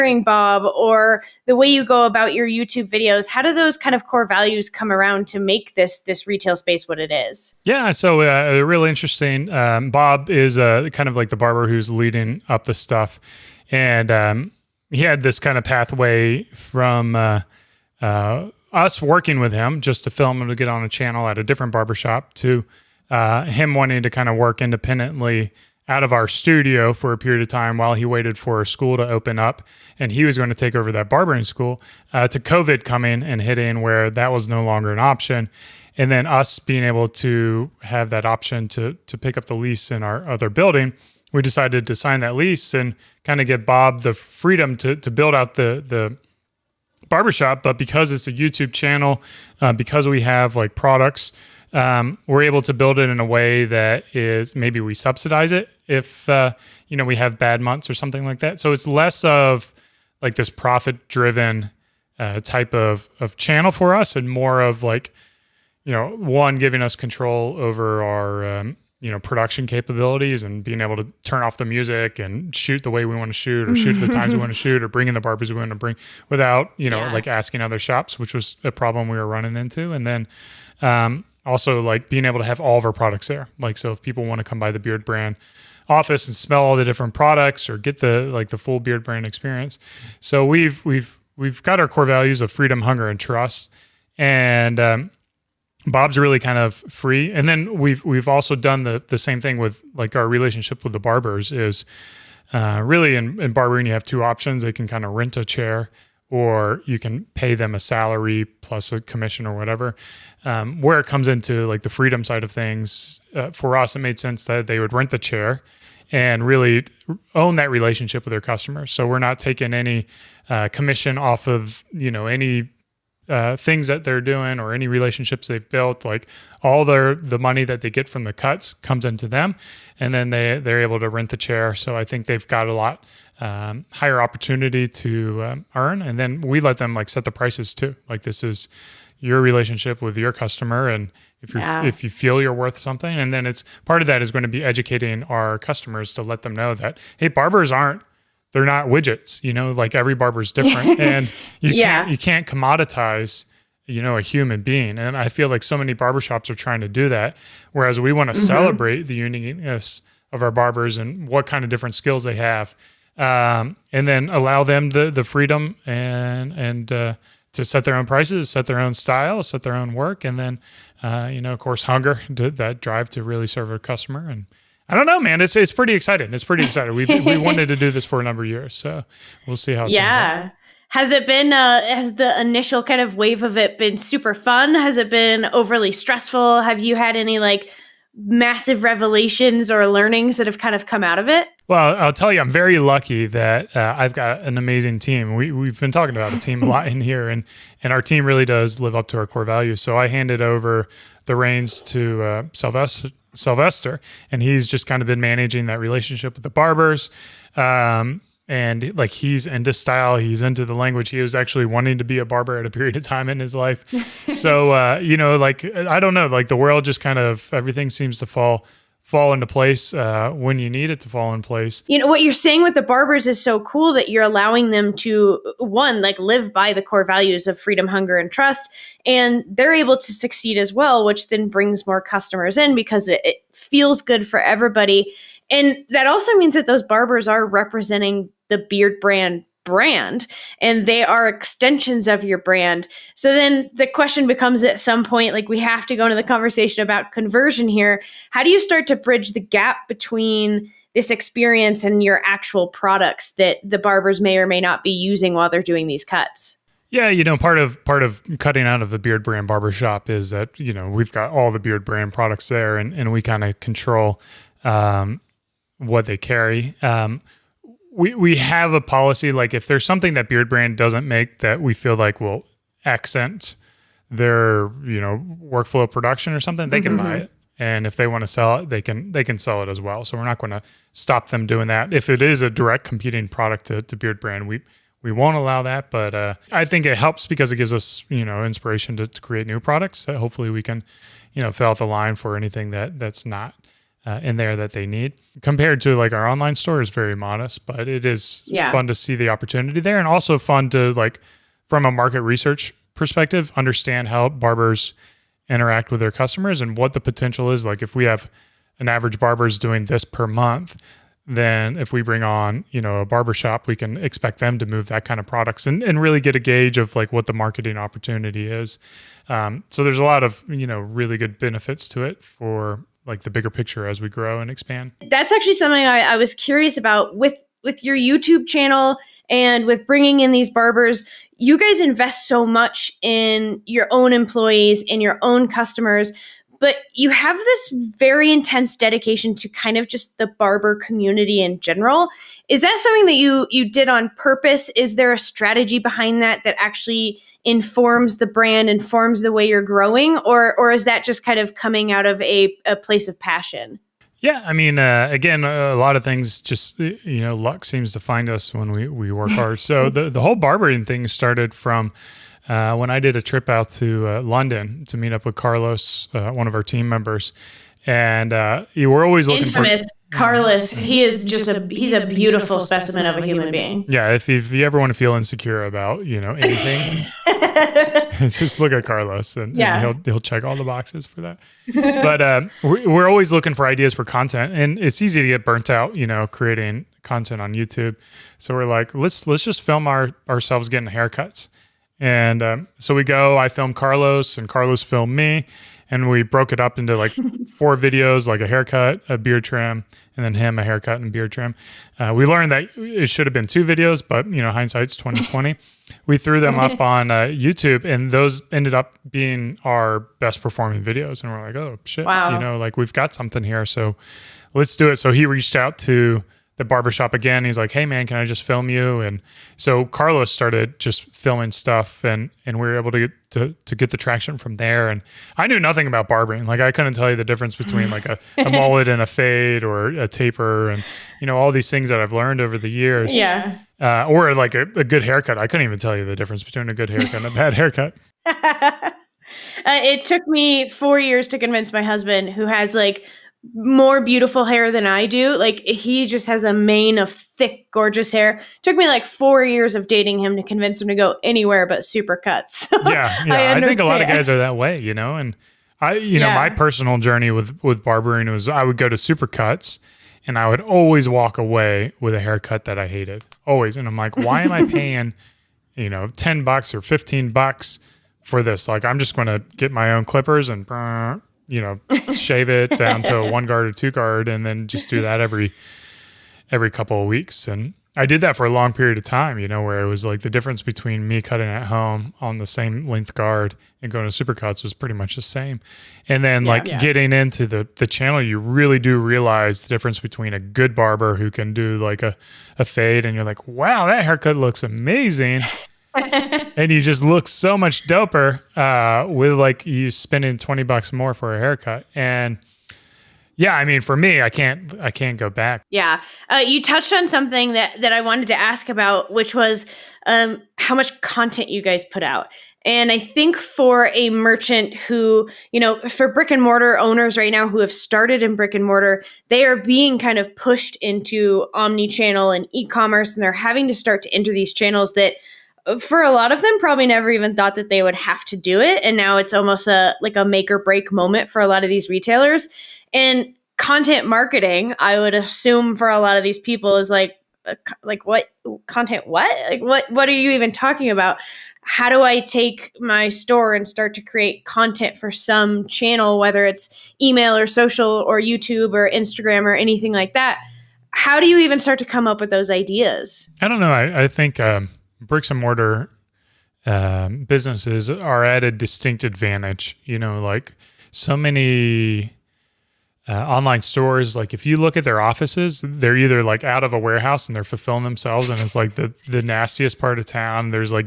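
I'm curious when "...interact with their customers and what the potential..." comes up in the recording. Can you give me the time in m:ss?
5:05.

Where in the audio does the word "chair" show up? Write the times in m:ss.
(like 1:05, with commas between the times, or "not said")
1:45, 1:55, 2:11.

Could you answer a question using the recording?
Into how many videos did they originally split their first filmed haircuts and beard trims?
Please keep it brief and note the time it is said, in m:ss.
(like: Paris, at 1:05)
4, at 6:37.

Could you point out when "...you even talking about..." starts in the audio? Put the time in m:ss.
9:00.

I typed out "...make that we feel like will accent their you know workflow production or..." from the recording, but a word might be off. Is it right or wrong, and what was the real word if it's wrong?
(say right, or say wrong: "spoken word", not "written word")
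right.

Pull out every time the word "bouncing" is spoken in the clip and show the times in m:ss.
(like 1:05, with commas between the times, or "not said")
not said.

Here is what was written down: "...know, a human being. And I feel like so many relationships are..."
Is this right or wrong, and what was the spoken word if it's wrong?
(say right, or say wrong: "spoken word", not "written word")
wrong: "barbershops", not "relationships".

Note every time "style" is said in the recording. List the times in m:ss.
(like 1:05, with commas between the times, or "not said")
2:48, 3:29.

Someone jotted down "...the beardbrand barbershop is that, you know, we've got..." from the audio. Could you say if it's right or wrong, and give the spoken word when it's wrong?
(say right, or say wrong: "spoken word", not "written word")
right.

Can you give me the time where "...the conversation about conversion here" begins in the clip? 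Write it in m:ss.
4:06.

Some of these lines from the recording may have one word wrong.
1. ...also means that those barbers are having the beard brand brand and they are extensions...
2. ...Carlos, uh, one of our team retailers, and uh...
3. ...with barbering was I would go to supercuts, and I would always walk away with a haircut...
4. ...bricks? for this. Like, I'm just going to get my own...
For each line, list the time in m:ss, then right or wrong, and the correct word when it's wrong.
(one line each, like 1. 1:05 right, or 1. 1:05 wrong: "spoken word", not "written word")
1. 3:56 wrong: "representing", not "having"
2. 6:05 wrong: "members", not "retailers"
3. 7:37 right
4. 7:47 wrong: "bucks", not "bricks".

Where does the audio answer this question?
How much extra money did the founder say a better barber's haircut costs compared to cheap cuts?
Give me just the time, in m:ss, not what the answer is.
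8:20.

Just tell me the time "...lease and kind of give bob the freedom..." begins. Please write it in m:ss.
0:42.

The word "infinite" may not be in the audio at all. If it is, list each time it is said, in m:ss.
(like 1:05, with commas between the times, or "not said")
not said.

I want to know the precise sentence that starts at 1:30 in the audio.
So we've we've we've got our core values of freedom, hunger, and trust, and um, Bob's really kind of free.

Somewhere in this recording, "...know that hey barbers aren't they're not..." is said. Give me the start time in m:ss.
2:26.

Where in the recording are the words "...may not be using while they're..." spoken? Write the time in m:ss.
4:14.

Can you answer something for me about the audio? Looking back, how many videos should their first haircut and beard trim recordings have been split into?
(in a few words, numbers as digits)
2.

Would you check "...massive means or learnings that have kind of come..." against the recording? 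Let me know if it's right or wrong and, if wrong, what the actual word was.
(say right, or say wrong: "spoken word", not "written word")
wrong: "revelations", not "means".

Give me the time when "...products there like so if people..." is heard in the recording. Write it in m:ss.
1:22.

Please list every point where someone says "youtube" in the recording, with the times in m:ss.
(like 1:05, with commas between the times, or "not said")
0:02, 0:48, 5:27, 6:27, 6:47, 9:08.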